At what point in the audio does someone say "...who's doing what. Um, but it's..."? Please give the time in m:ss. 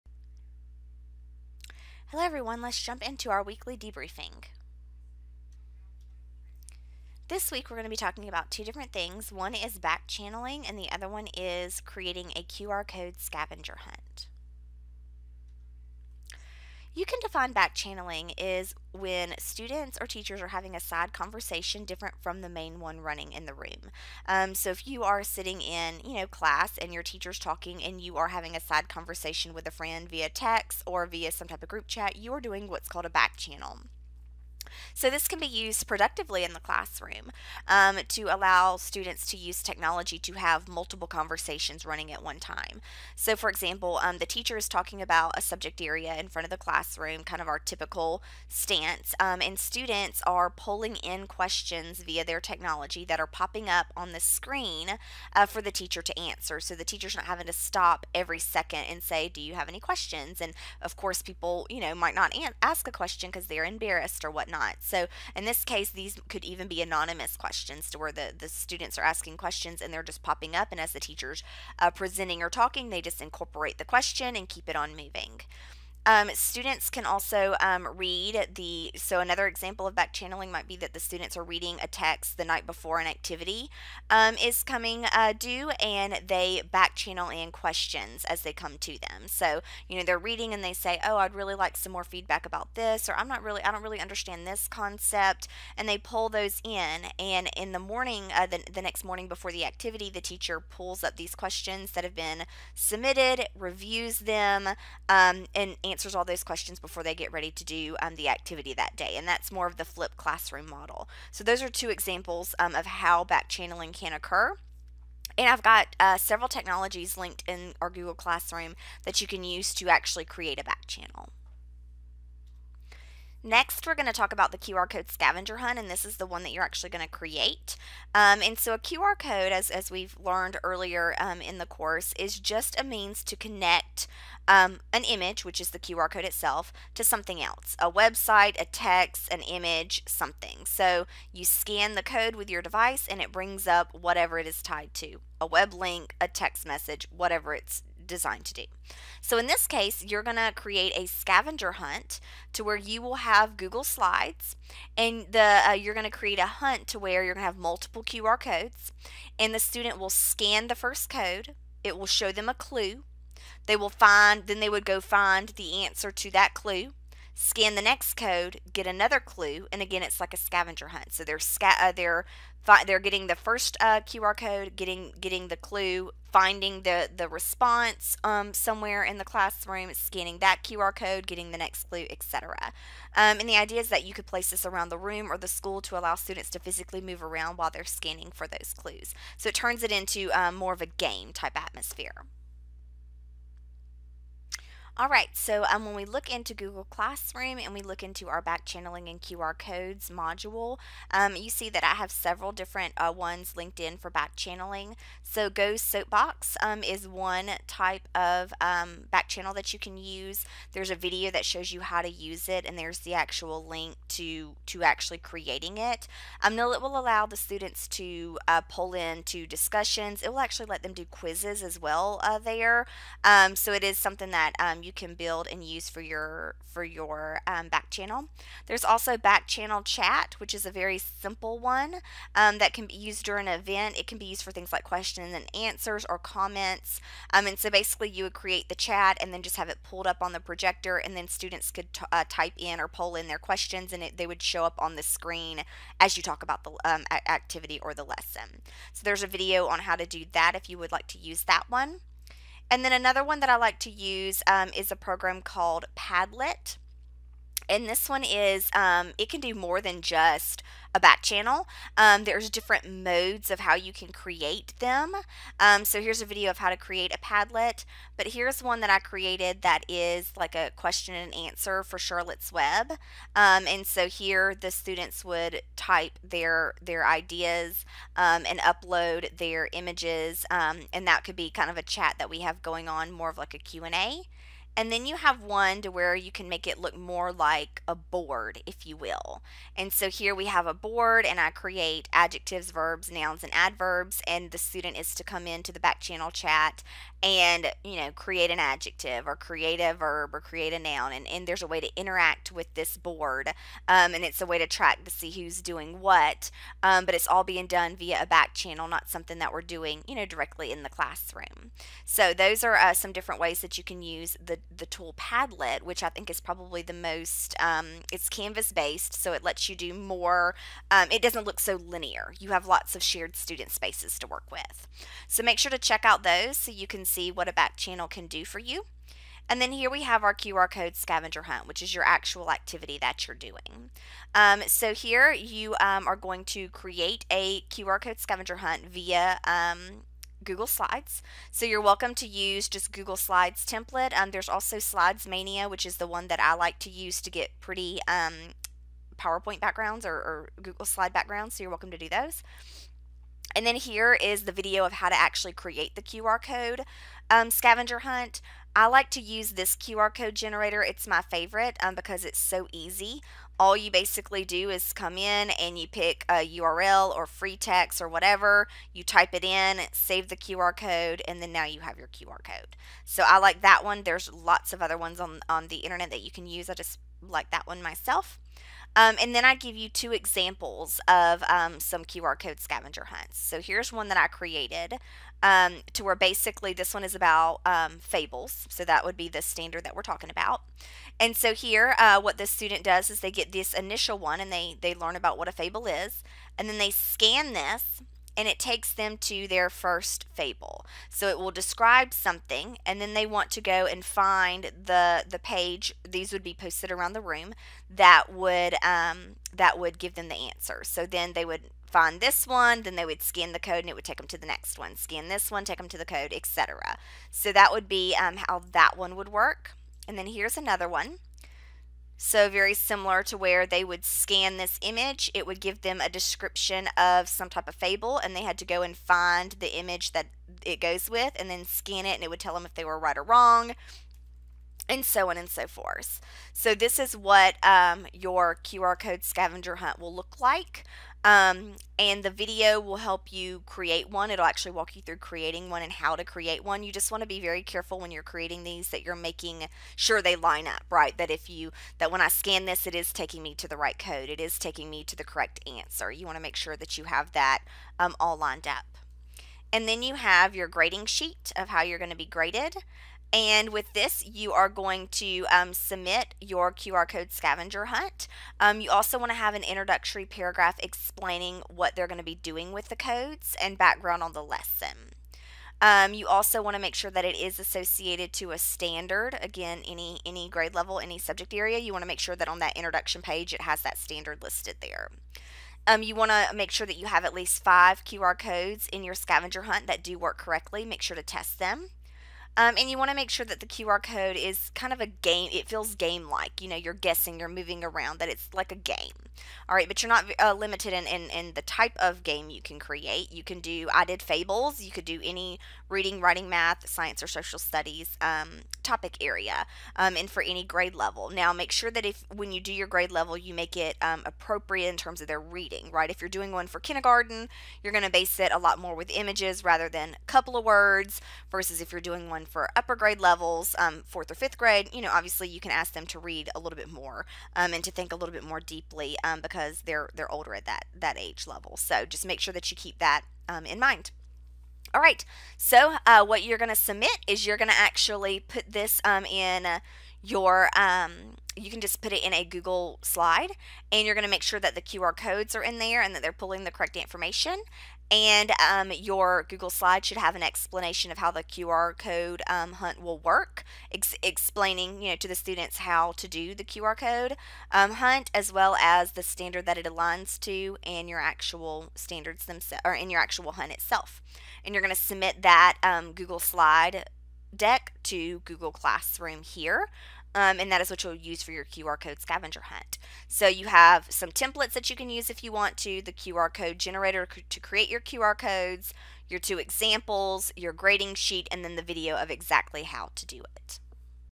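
5:05.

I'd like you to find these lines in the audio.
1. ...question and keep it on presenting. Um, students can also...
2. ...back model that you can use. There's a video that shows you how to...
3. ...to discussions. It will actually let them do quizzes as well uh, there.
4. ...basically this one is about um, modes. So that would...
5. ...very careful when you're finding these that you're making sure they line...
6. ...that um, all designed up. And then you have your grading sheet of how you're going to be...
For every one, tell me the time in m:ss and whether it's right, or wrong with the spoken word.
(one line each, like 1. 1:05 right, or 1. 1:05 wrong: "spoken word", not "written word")
1. 1:13 wrong: "moving", not "presenting"
2. 3:29 wrong: "channel", not "model"
3. 3:39 right
4. 6:26 wrong: "fables", not "modes"
5. 7:27 wrong: "creating", not "finding"
6. 7:37 wrong: "lined", not "designed".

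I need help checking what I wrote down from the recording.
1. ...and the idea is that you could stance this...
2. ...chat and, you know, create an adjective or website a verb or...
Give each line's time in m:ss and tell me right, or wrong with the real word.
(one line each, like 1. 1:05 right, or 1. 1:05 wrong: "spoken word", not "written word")
1. 3:03 wrong: "place", not "stance"
2. 4:56 wrong: "create", not "website".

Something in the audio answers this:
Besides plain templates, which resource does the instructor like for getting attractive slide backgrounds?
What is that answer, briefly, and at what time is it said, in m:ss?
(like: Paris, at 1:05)
Slides Mania, at 5:44.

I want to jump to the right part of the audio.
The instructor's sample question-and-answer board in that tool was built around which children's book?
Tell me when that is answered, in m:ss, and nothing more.
4:31.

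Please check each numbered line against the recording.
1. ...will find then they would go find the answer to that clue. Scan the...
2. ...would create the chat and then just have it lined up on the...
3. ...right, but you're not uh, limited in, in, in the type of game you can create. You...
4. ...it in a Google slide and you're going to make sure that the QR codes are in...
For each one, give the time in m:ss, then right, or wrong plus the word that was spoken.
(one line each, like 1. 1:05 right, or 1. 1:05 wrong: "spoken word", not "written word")
1. 2:43 right
2. 3:58 wrong: "pulled", not "lined"
3. 8:19 right
4. 9:02 right.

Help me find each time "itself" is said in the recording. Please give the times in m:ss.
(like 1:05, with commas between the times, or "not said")
2:16, 9:23.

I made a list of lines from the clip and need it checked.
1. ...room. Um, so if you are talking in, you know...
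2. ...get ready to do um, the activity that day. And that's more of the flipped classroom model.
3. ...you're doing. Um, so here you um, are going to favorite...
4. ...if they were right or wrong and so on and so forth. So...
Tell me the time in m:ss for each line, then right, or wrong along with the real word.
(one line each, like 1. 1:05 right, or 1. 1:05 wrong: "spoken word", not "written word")
1. 0:23 wrong: "sitting", not "talking"
2. 1:47 right
3. 5:33 wrong: "create", not "favorite"
4. 7:12 right.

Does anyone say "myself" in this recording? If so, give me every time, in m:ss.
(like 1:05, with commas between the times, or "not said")
6:17.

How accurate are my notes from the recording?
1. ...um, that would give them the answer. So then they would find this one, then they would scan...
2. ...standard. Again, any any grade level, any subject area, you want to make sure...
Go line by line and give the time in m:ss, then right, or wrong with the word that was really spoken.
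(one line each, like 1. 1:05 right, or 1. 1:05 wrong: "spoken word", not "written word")
1. 6:48 right
2. 7:58 right.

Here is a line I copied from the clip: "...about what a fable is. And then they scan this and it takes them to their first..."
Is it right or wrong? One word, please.
right.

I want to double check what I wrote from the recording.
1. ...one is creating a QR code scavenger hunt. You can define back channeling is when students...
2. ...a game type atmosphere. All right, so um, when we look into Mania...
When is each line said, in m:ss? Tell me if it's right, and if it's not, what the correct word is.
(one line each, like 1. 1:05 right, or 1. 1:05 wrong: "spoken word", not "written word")
1. 0:11 right
2. 3:10 wrong: "Google", not "Mania".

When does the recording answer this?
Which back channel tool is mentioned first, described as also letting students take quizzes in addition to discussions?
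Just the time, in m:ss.
3:25.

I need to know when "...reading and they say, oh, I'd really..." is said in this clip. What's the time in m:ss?
1:30.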